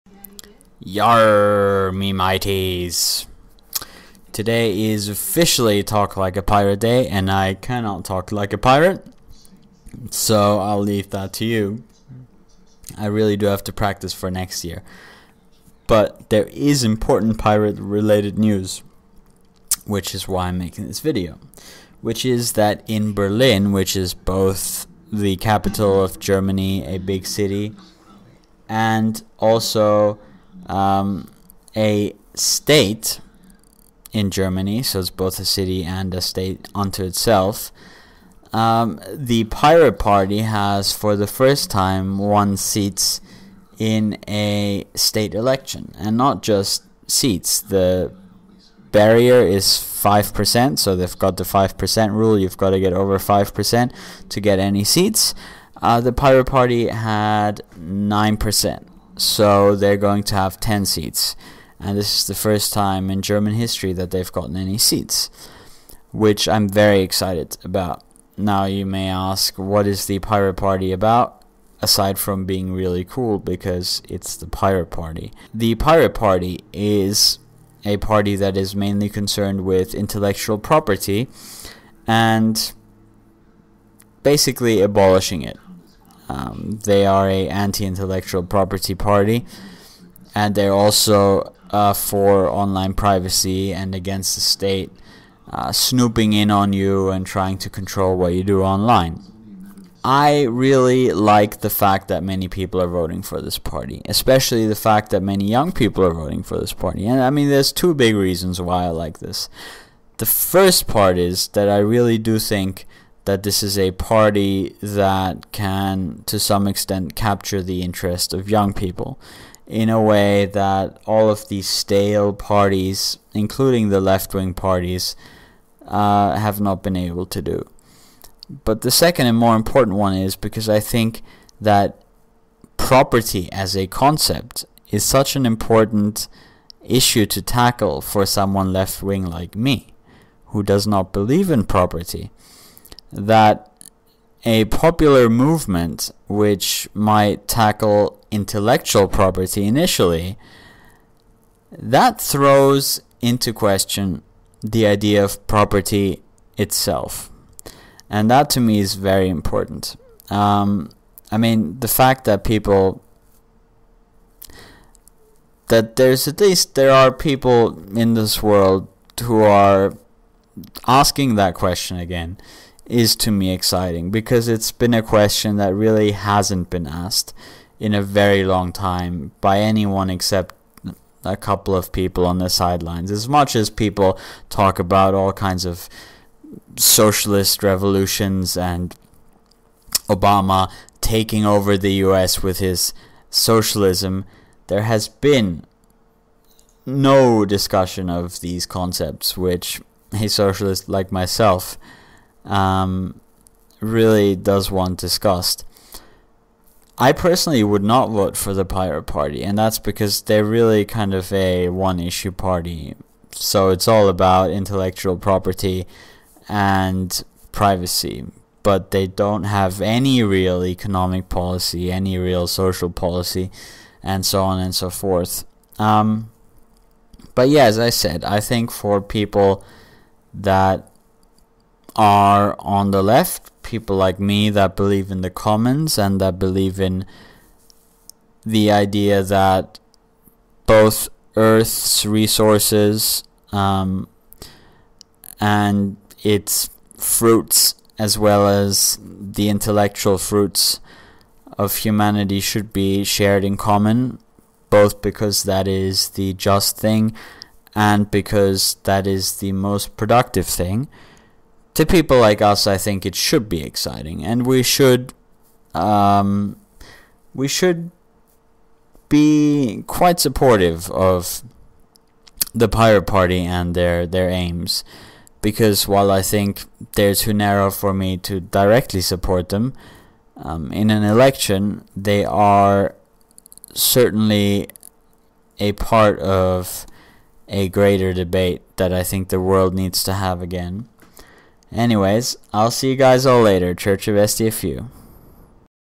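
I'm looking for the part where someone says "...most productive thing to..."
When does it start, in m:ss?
4:19.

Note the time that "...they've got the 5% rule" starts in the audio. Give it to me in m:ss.
0:50.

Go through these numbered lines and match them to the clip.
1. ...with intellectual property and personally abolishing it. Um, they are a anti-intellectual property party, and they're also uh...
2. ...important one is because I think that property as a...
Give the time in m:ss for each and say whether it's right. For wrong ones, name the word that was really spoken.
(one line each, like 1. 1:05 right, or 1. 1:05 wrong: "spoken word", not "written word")
1. 1:19 wrong: "basically", not "personally"
2. 2:09 right.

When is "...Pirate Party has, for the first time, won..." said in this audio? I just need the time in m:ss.
0:39.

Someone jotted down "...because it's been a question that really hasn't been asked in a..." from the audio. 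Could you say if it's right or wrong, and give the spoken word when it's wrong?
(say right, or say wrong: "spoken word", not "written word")
right.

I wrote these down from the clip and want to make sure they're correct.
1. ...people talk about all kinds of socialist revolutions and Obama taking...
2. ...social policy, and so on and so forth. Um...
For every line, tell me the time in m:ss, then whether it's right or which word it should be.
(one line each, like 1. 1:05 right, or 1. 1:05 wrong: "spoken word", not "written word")
1. 3:03 right
2. 3:42 right.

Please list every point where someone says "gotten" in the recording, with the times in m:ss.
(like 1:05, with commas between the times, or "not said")
1:04.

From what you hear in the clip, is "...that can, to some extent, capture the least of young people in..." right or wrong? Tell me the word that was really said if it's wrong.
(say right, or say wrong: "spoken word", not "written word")
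wrong: "interest", not "least".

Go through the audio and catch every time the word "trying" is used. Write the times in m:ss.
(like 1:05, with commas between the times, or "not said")
1:37.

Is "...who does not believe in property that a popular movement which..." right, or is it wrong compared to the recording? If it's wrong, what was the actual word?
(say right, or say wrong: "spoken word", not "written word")
right.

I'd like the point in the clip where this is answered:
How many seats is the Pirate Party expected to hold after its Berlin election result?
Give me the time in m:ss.
1:00.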